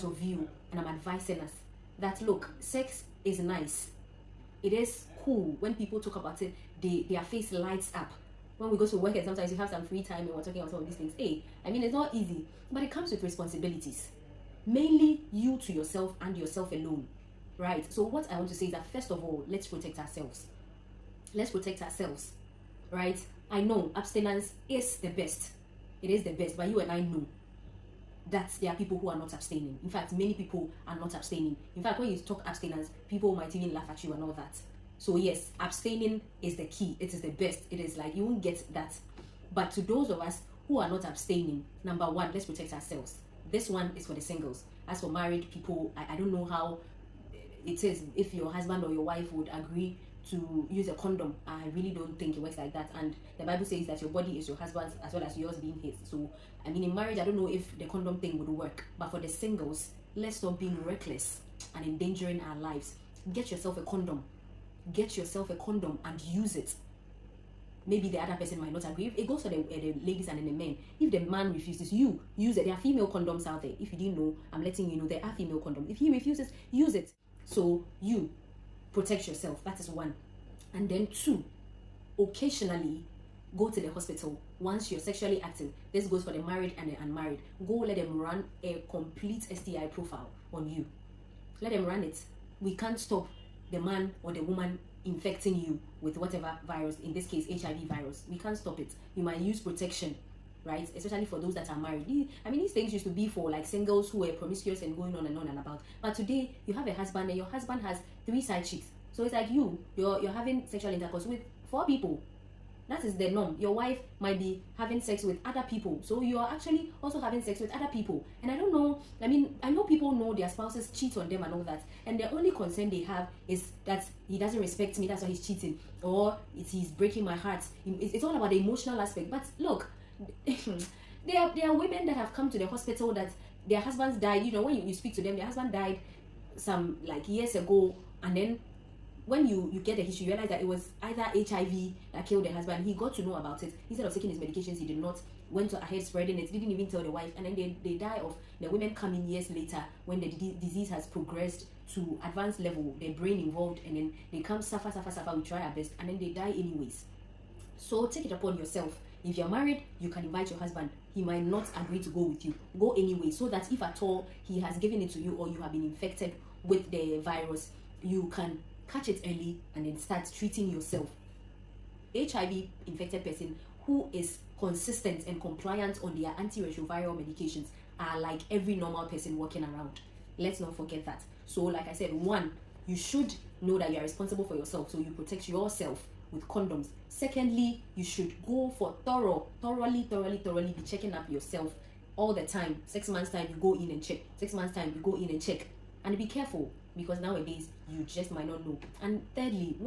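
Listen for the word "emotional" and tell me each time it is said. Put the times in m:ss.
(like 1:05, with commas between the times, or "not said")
2:08.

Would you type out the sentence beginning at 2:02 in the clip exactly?
And the only concern they have is that he doesn't respect me, that's why he's cheating.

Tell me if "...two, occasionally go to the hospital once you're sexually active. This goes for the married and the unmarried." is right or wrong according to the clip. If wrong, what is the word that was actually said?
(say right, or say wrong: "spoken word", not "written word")
right.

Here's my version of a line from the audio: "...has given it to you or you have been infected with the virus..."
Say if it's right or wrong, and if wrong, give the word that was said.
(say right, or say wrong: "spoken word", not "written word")
right.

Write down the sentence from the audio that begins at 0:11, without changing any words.
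Hey, I mean, it's not easy, but it comes with responsibilities.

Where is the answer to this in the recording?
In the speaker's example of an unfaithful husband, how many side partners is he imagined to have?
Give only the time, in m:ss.
1:48.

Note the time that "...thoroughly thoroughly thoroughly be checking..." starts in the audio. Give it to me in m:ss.
3:09.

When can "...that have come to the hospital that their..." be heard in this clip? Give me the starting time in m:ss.
2:12.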